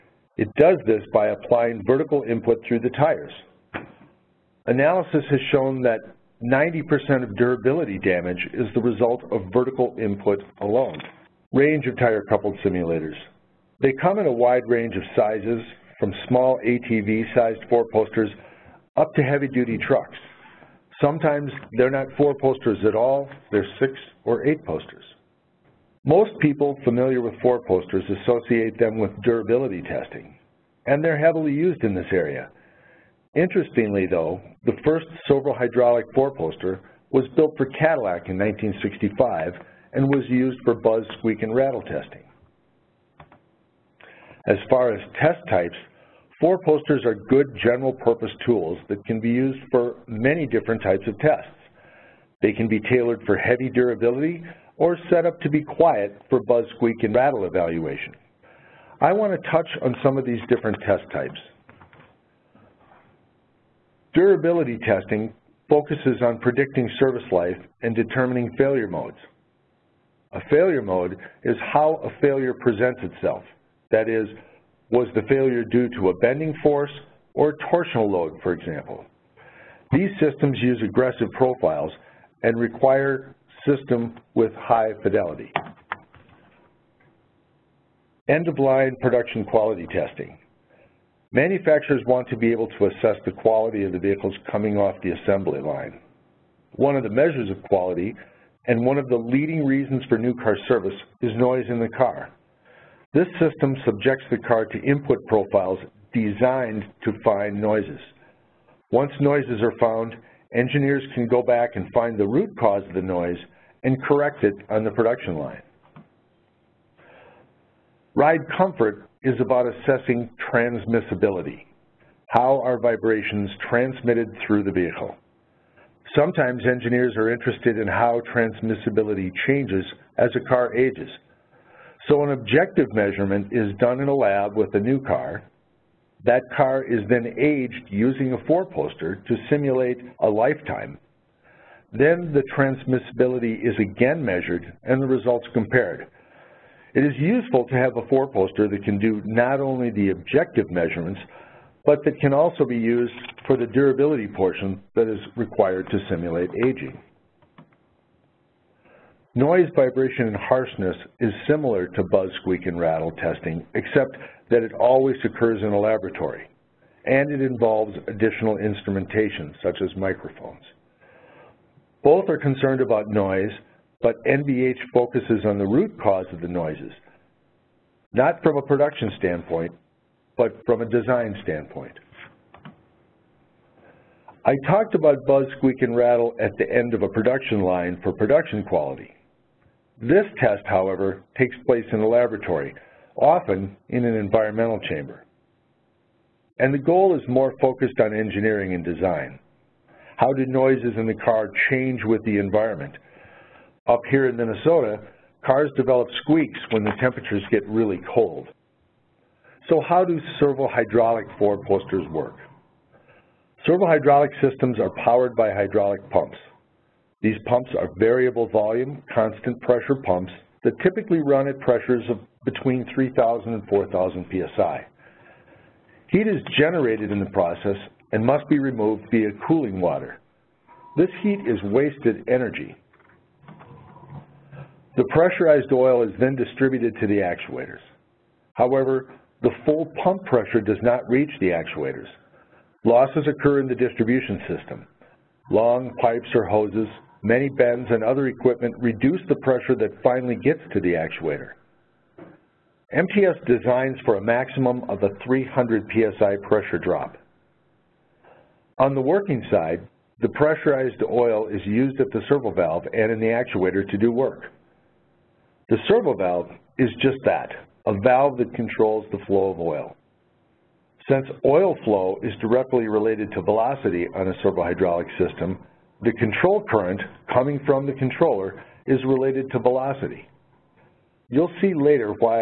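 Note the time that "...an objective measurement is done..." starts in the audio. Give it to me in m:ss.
2:12.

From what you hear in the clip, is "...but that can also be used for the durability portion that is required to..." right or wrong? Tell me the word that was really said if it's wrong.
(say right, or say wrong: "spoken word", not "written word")
right.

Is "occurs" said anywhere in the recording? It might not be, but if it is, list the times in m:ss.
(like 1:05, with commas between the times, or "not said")
2:45, 4:03.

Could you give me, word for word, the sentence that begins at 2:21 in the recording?
Then the transmissibility is again measured and the results compared.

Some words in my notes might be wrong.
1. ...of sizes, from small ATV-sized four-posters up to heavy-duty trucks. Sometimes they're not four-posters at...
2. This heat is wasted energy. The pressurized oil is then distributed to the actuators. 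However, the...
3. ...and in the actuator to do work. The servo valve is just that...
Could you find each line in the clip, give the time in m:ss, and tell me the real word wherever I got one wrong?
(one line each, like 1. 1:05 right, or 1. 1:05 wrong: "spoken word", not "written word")
1. 0:14 right
2. 3:50 right
3. 4:22 right.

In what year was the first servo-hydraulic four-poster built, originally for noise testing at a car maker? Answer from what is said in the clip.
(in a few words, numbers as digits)
1965.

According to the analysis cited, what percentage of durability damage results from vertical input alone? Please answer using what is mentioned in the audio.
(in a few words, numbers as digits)
90%.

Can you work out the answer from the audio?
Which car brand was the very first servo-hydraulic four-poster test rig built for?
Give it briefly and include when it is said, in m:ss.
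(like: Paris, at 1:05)
Cadillac, at 0:37.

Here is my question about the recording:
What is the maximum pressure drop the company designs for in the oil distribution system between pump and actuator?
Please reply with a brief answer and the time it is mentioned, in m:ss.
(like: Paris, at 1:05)
300 psi, at 4:15.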